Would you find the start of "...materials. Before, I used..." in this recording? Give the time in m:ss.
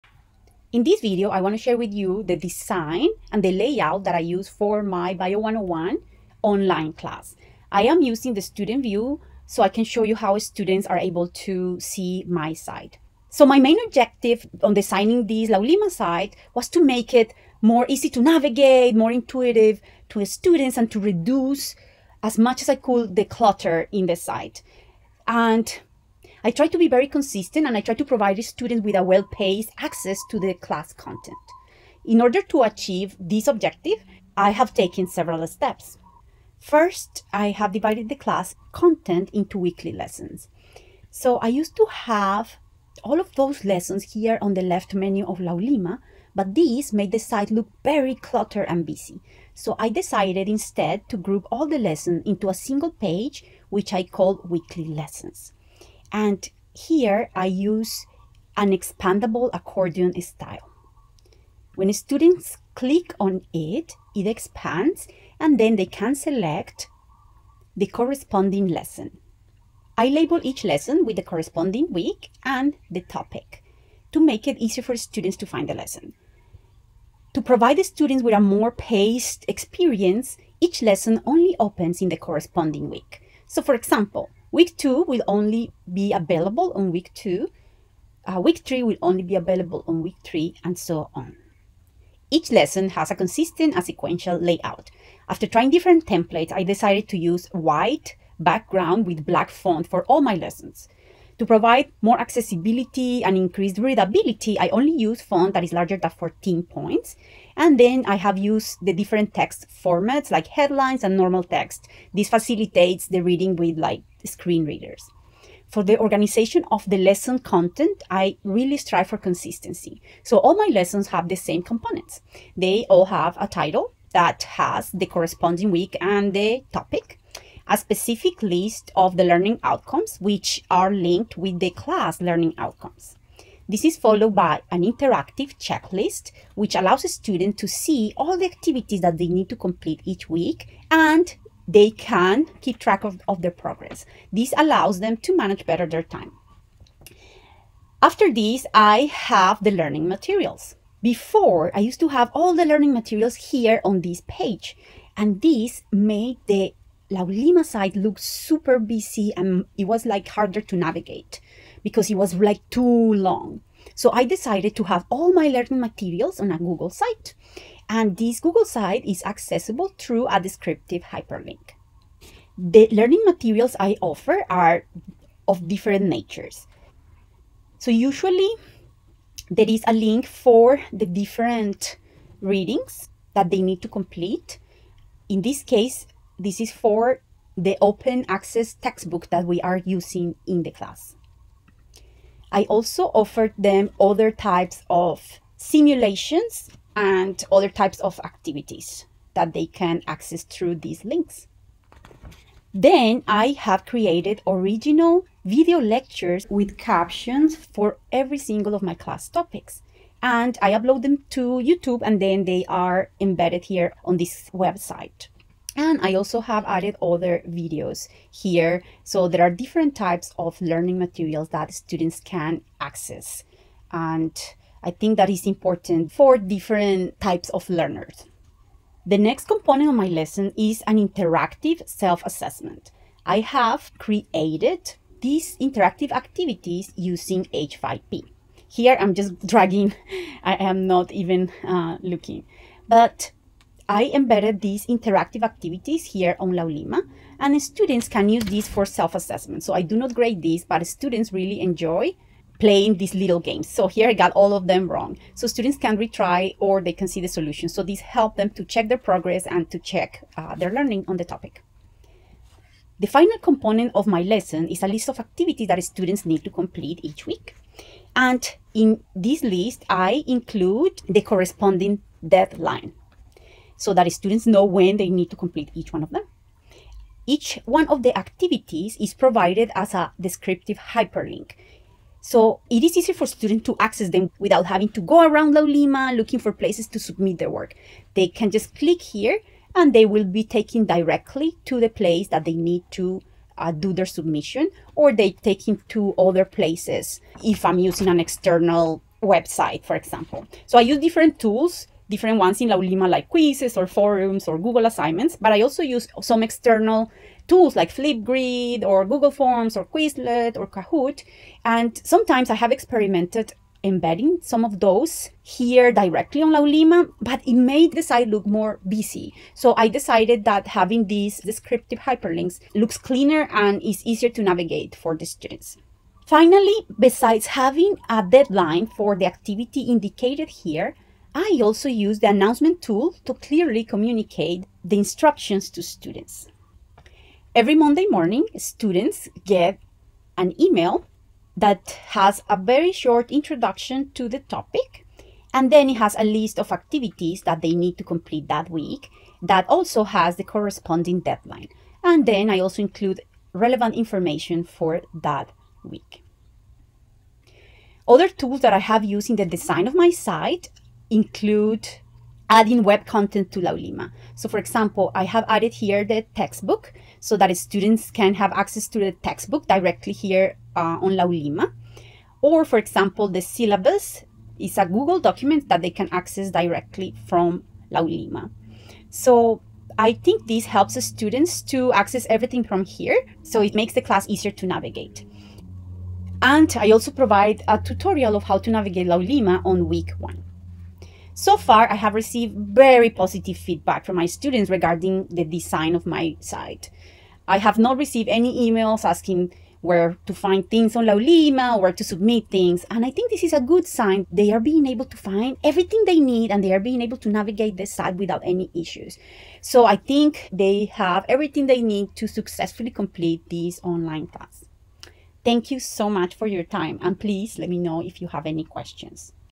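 2:30.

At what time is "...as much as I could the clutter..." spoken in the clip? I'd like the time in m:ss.
0:22.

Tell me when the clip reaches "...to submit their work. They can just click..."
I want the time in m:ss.
4:46.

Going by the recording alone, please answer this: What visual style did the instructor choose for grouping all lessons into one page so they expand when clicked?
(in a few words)
expandable accordion style.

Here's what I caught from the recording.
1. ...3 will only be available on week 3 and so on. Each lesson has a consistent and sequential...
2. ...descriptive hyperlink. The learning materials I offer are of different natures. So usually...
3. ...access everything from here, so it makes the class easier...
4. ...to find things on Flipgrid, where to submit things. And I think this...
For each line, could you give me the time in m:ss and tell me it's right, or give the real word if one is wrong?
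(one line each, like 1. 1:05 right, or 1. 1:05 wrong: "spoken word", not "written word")
1. 1:28 right
2. 2:50 right
3. 6:21 right
4. 6:40 wrong: "Laulima", not "Flipgrid".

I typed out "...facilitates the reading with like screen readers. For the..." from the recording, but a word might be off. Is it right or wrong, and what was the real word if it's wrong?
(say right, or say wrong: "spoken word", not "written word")
right.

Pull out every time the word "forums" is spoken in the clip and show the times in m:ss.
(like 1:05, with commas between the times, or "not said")
5:03.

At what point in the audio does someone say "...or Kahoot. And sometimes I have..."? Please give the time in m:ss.
5:10.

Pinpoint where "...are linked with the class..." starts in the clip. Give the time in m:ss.
2:10.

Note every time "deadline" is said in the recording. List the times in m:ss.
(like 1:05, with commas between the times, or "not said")
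4:32, 5:28, 5:51.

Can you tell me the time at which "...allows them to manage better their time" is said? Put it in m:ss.
2:24.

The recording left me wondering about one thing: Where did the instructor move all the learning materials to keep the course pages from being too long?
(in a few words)
a Google site.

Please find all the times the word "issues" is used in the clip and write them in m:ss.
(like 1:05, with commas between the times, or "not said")
6:48.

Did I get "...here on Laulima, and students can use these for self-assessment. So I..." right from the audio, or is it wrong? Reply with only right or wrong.
right.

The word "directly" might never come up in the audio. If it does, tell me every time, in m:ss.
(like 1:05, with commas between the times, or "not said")
4:50, 5:15, 6:09, 6:16.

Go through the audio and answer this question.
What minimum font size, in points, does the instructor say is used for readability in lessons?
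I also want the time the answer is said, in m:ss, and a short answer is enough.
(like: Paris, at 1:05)
14, at 1:46.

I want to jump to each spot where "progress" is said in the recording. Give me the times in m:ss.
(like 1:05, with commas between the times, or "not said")
2:23, 4:18.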